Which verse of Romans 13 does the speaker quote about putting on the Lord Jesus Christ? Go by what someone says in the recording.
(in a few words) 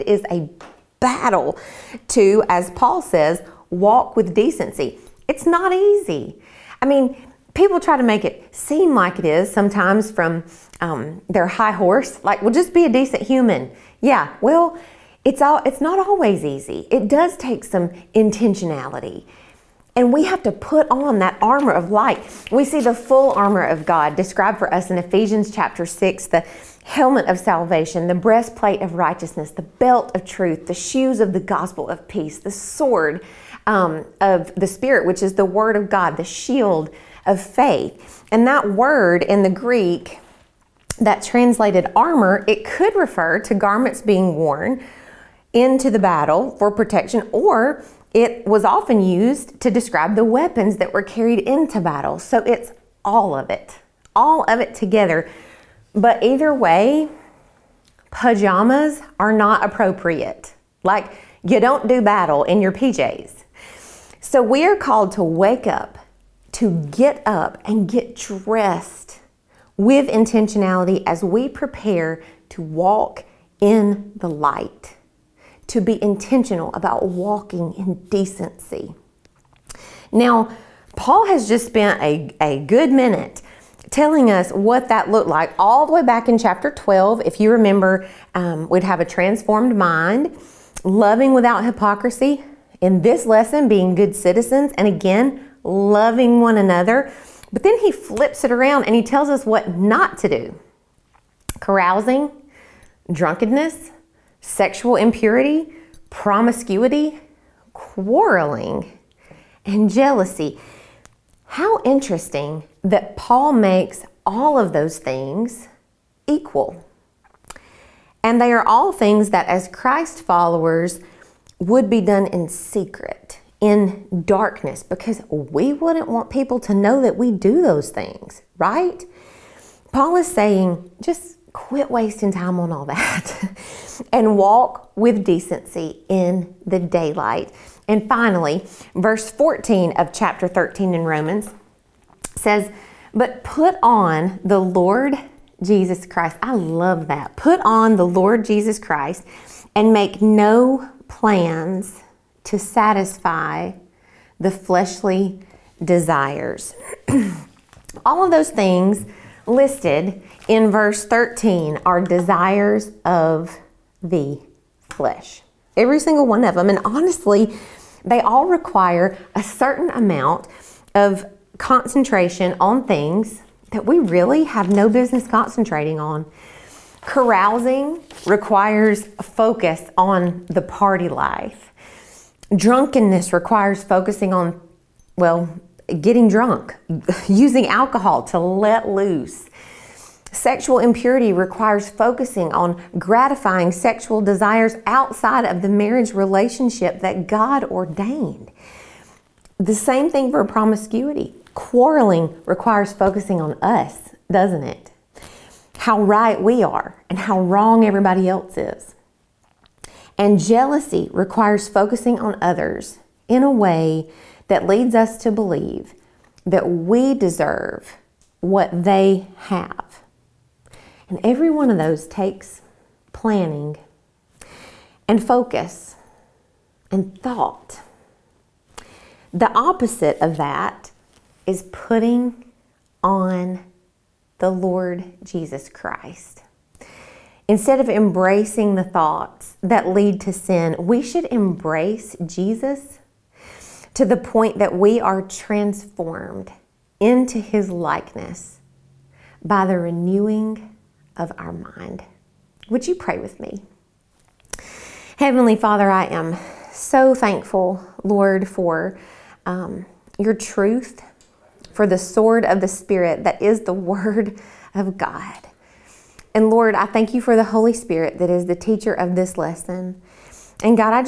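Verse 14.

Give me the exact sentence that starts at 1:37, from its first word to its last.
But then he flips it around and he tells us what not to do carousing, drunkenness, sexual impurity, promiscuity, quarreling, and jealousy.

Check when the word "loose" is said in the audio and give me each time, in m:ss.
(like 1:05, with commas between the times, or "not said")
3:08.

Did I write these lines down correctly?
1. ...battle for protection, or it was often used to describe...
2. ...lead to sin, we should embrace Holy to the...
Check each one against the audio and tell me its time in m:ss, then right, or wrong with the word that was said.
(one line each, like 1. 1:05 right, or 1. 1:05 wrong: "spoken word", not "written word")
1. 0:45 right
2. 3:59 wrong: "Jesus", not "Holy".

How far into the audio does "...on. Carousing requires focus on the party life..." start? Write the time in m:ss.
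2:55.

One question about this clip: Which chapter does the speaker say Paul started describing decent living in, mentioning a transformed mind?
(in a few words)
Chapter 12.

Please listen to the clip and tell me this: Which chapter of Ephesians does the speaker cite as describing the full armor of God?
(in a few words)
Chapter 6.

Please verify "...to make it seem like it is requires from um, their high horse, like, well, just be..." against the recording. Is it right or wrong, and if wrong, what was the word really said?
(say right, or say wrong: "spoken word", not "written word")
wrong: "sometimes", not "requires".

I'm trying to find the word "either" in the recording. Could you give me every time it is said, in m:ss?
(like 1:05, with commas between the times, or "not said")
0:56.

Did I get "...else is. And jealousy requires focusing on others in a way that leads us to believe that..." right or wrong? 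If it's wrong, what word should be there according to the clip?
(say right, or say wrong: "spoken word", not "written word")
right.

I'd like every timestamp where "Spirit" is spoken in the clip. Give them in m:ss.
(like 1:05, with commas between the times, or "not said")
0:34, 4:22, 4:27.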